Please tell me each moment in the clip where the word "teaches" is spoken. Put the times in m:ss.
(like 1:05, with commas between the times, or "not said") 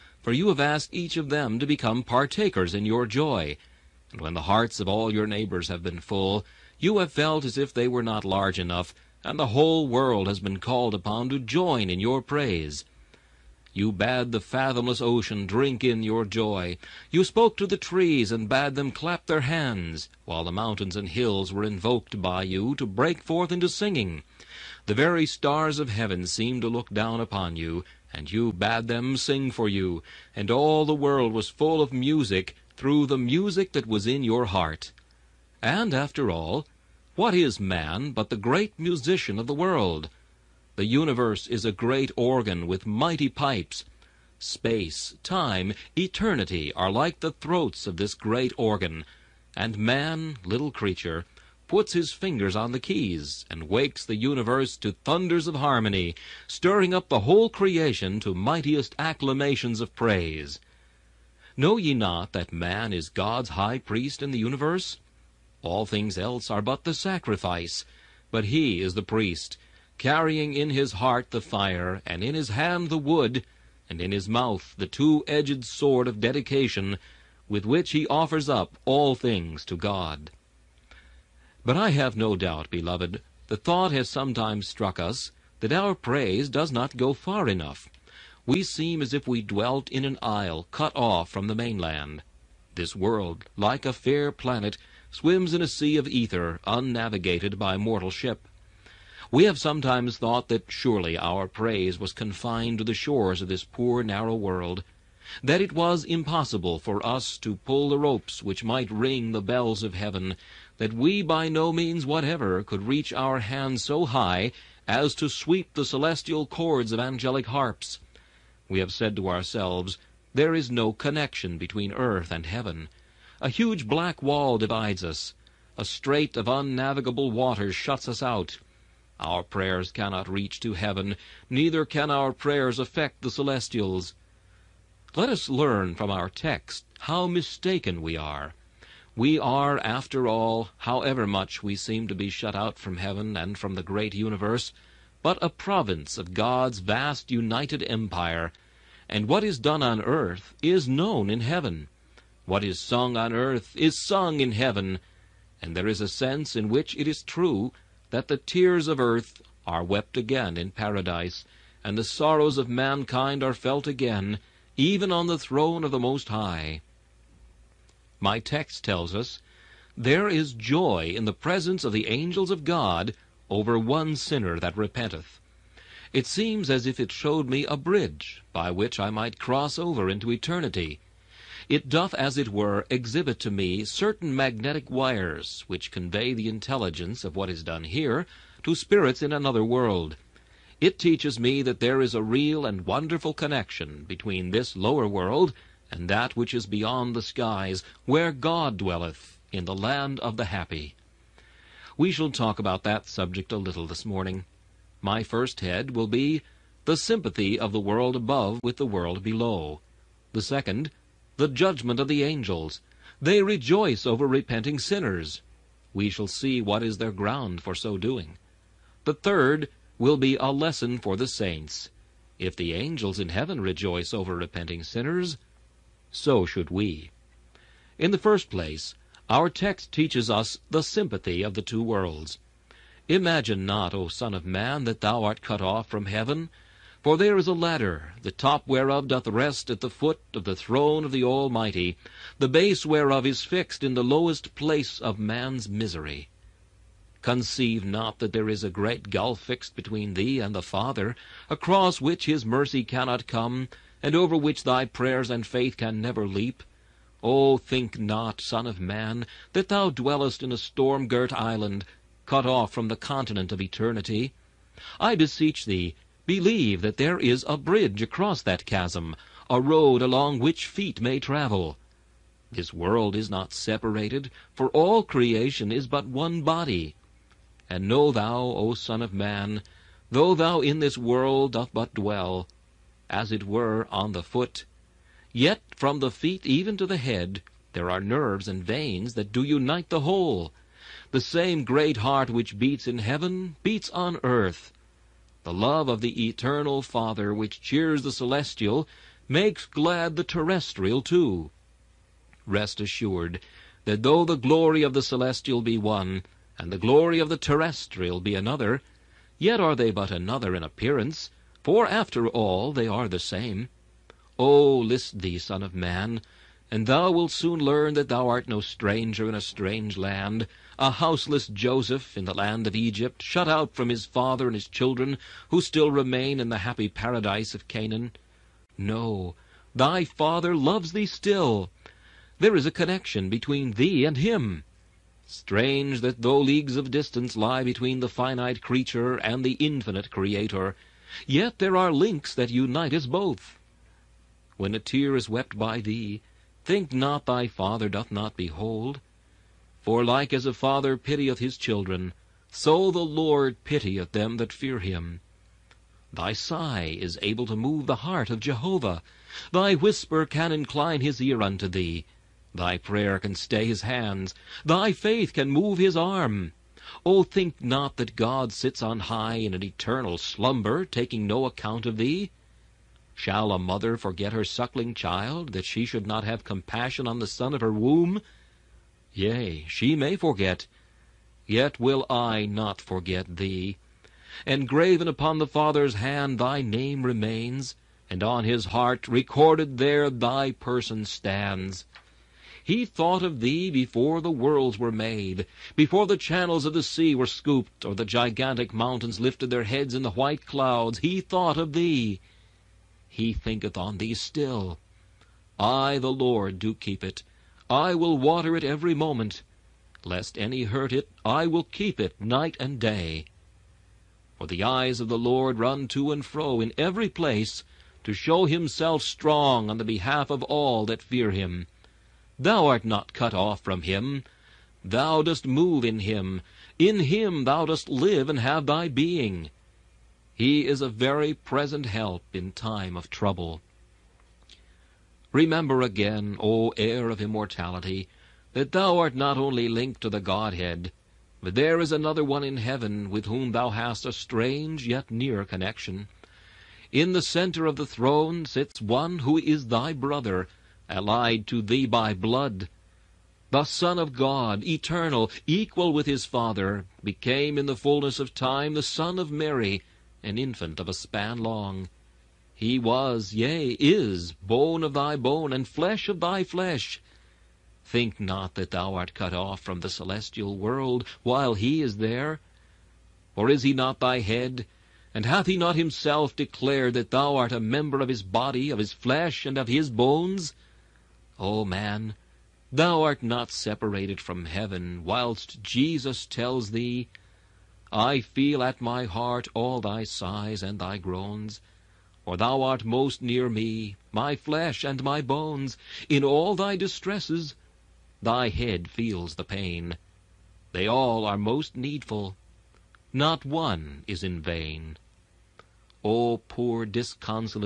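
3:10, 3:49.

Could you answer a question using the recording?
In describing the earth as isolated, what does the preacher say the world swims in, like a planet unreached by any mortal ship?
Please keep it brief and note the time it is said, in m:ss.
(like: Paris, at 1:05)
A sea of ether, at 1:35.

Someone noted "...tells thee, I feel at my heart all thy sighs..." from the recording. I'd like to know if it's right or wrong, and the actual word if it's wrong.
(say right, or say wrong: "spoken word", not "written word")
right.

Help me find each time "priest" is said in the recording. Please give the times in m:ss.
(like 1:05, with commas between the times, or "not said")
1:03, 1:09.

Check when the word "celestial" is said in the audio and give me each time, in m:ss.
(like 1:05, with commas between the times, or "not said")
1:55, 2:13, 4:58, 5:05, 7:49.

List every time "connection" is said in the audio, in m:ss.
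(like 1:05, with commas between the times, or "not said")
2:00, 3:13, 5:32, 7:25.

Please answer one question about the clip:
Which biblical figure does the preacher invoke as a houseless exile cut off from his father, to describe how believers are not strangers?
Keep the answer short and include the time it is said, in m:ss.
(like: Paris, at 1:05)
Joseph, at 5:21.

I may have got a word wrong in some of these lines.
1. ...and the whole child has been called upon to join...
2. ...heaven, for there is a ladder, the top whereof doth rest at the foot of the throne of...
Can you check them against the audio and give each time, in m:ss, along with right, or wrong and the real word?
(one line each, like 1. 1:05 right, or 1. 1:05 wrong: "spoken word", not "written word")
1. 0:09 wrong: "world", not "child"
2. 3:56 right.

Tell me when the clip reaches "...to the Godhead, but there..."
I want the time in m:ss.
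7:20.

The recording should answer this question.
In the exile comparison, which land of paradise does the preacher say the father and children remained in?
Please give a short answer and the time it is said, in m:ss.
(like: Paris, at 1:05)
Canaan, at 5:27.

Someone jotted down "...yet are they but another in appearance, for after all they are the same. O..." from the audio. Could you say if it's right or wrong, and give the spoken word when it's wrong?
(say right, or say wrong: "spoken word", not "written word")
right.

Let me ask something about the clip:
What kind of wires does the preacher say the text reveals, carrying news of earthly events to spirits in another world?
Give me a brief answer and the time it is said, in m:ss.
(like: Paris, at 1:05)
Magnetic wires, at 3:04.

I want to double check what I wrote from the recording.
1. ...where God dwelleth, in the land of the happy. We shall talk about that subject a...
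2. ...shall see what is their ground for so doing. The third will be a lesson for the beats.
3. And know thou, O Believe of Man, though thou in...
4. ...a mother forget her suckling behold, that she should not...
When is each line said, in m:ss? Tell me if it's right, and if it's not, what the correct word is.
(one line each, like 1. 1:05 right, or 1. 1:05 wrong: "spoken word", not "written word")
1. 3:18 right
2. 3:36 wrong: "saints", not "beats"
3. 4:37 wrong: "Son", not "Believe"
4. 6:13 wrong: "child", not "behold".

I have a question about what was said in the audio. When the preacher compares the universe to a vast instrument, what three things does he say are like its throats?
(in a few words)
Space, time, eternity.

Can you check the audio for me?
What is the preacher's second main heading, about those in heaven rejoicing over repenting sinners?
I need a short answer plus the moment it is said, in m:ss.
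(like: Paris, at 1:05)
The judgment of the angels, at 3:31.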